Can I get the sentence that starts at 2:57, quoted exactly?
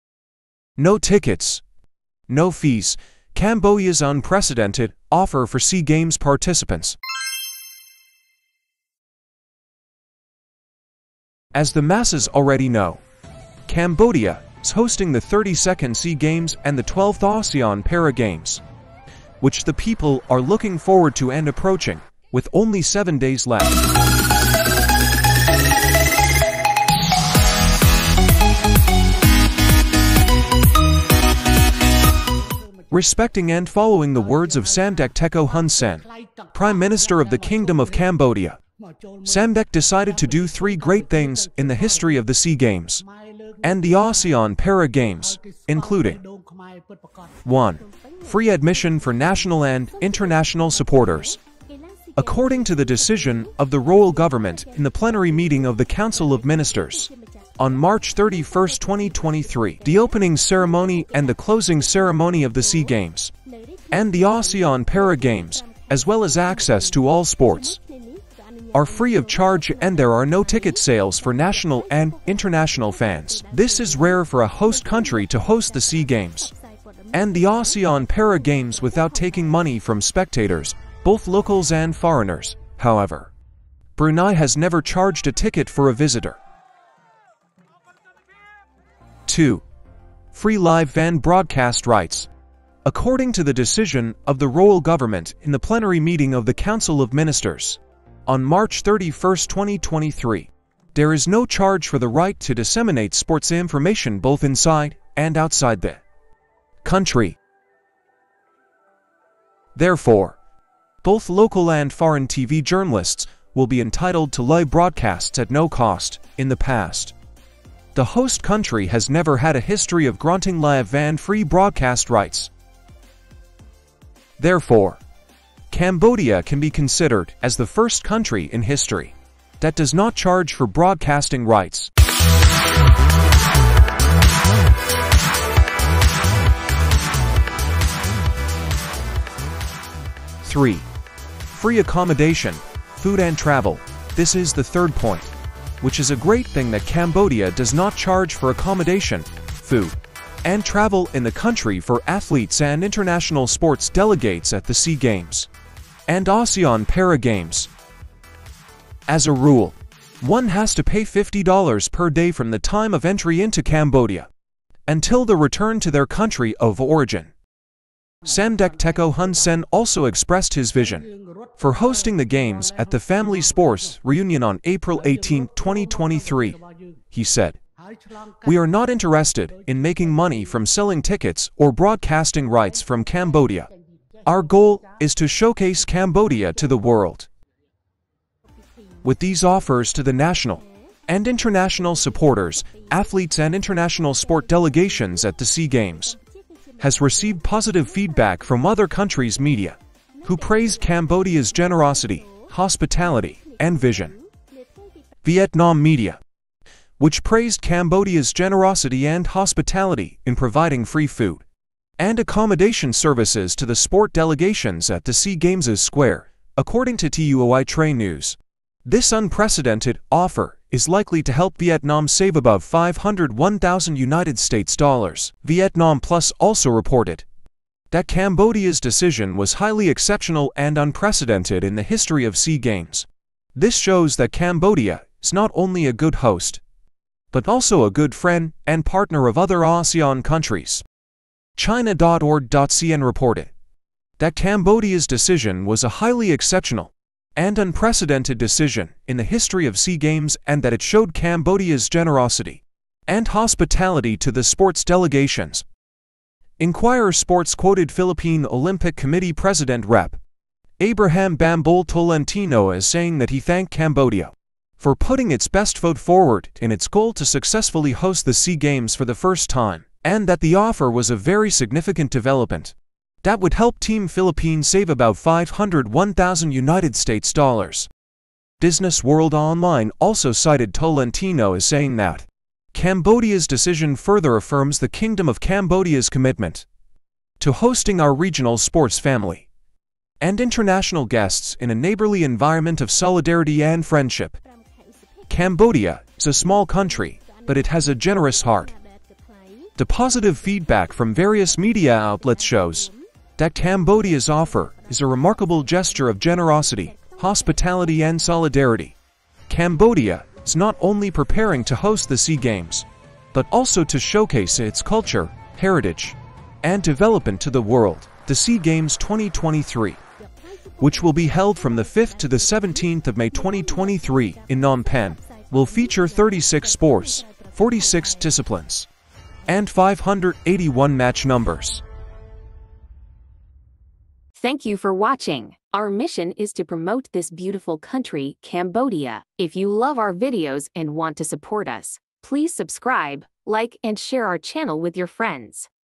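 He said, We are not interested in making money from selling tickets or broadcasting rights from Cambodia.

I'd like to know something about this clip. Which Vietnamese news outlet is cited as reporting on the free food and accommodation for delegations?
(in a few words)
Tuoi Tre News.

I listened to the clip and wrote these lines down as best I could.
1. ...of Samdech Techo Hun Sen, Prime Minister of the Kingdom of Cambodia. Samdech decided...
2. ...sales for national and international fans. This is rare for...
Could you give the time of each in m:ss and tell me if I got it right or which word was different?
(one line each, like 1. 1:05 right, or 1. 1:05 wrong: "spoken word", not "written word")
1. 0:34 right
2. 1:10 right.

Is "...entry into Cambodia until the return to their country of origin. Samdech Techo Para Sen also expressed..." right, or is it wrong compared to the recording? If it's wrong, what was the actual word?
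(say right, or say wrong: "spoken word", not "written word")
wrong: "Hun", not "Para".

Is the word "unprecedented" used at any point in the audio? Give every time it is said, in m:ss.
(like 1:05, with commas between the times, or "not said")
0:04, 3:39, 3:50, 4:07.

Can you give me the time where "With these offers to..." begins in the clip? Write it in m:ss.
3:09.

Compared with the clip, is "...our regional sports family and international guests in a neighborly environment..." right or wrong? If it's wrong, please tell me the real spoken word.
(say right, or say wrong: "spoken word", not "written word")
right.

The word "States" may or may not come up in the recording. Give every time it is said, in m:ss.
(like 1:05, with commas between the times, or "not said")
3:44, 4:36.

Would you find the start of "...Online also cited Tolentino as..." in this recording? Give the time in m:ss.
4:39.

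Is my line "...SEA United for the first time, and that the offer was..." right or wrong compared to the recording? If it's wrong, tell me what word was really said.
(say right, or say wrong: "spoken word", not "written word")
wrong: "Games", not "United".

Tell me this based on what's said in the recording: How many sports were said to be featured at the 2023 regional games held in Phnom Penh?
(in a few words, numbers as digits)
36.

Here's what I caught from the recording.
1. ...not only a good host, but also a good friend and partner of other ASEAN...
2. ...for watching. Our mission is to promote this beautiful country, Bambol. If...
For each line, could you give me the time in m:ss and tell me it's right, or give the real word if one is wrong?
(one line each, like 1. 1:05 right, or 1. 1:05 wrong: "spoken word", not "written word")
1. 3:55 right
2. 5:34 wrong: "Cambodia", not "Bambol".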